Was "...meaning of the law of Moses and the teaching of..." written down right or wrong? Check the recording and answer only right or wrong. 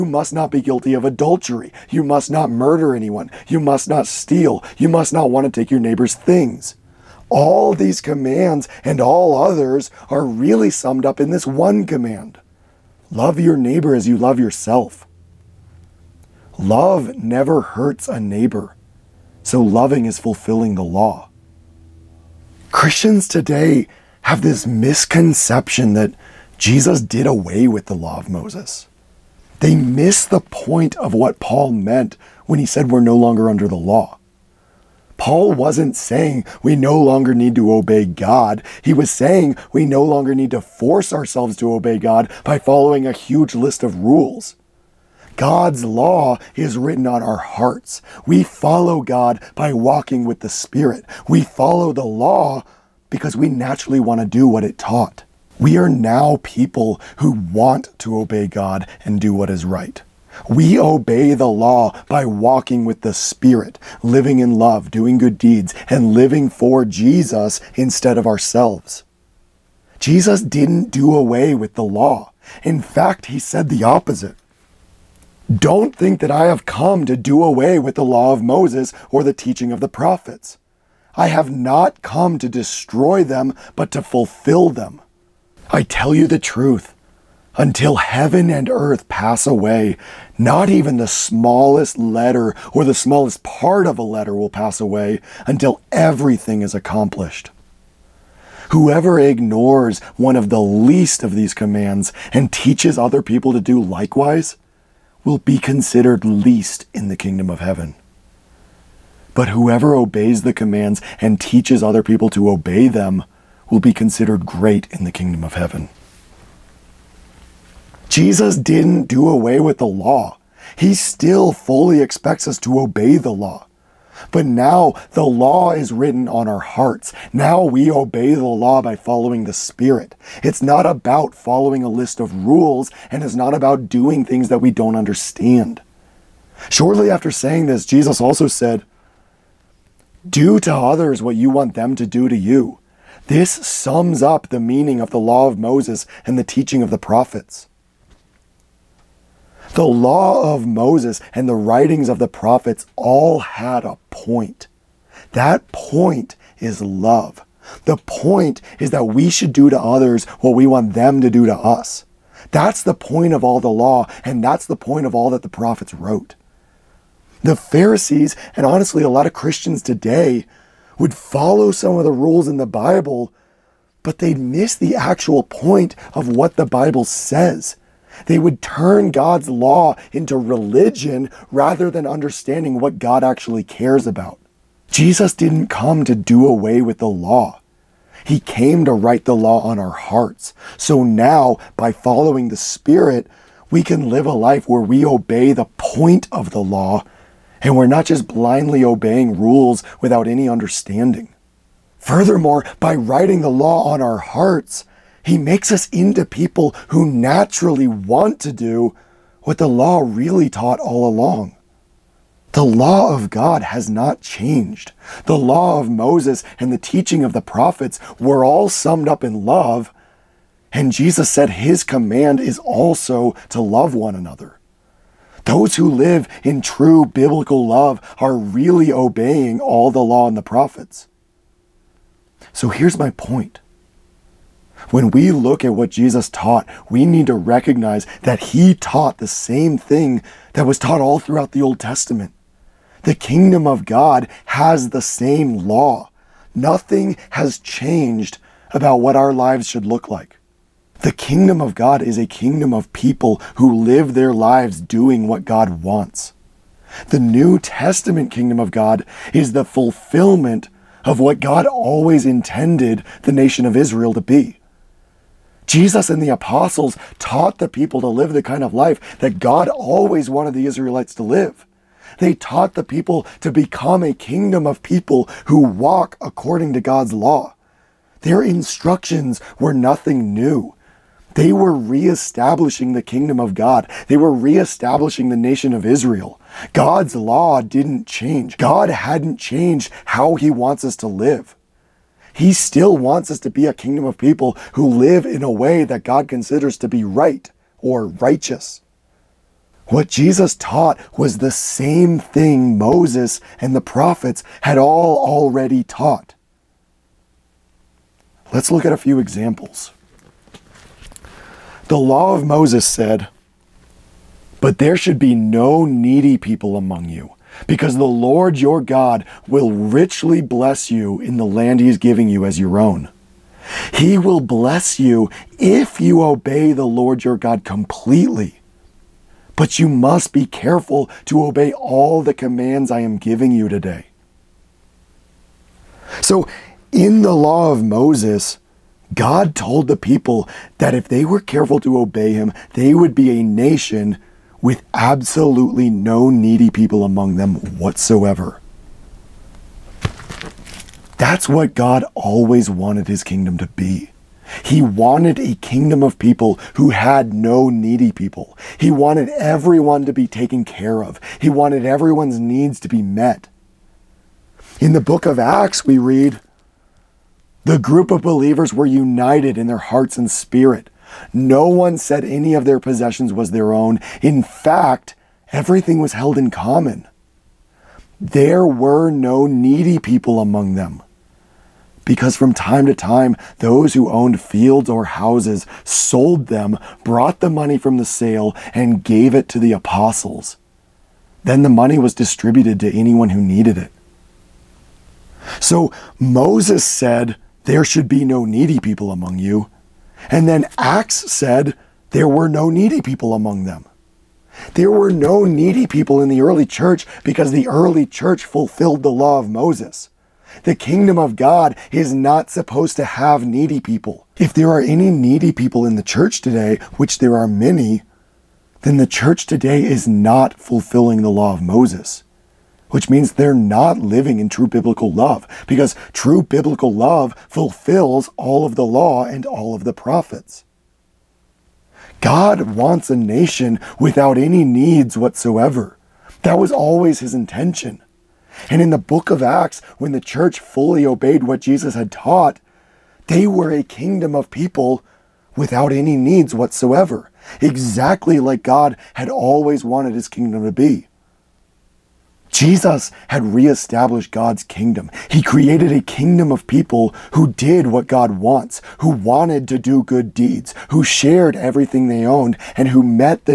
right.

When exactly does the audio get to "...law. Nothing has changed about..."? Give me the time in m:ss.
4:05.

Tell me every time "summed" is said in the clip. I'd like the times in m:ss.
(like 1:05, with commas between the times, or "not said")
0:10, 3:38.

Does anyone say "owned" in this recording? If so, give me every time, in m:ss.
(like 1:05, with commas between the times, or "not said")
6:24, 7:42.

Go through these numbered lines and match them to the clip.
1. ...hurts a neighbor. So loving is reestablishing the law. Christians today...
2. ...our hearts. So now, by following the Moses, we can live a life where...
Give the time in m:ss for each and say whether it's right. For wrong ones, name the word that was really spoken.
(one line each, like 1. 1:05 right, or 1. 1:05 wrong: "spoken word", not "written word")
1. 0:17 wrong: "fulfilling", not "reestablishing"
2. 3:09 wrong: "Spirit", not "Moses".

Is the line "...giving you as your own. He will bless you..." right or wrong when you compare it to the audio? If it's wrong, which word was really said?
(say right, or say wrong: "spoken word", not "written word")
right.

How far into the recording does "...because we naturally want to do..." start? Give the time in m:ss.
0:53.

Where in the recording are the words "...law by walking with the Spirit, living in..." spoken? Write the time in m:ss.
1:01.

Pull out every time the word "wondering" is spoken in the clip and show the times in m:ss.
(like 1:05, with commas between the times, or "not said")
not said.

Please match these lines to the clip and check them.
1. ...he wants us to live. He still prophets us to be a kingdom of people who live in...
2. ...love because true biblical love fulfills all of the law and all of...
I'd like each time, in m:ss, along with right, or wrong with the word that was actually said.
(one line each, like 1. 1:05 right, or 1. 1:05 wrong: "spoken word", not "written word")
1. 4:50 wrong: "wants", not "prophets"
2. 7:05 right.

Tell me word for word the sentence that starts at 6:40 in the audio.
And then Acts said there were no needy people among them.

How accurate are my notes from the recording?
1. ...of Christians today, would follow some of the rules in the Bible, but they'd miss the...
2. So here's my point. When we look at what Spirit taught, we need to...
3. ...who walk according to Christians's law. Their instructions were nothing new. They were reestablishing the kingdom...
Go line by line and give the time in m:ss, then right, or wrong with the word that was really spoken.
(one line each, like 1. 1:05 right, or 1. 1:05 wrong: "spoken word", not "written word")
1. 2:49 right
2. 3:52 wrong: "Jesus", not "Spirit"
3. 4:35 wrong: "God", not "Christians".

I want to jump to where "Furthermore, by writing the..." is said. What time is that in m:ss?
3:21.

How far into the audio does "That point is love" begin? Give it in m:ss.
2:35.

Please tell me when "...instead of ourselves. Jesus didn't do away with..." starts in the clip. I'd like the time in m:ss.
1:07.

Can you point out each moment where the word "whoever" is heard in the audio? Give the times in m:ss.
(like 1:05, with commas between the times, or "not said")
1:38, 1:49.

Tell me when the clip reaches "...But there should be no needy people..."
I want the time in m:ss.
5:14.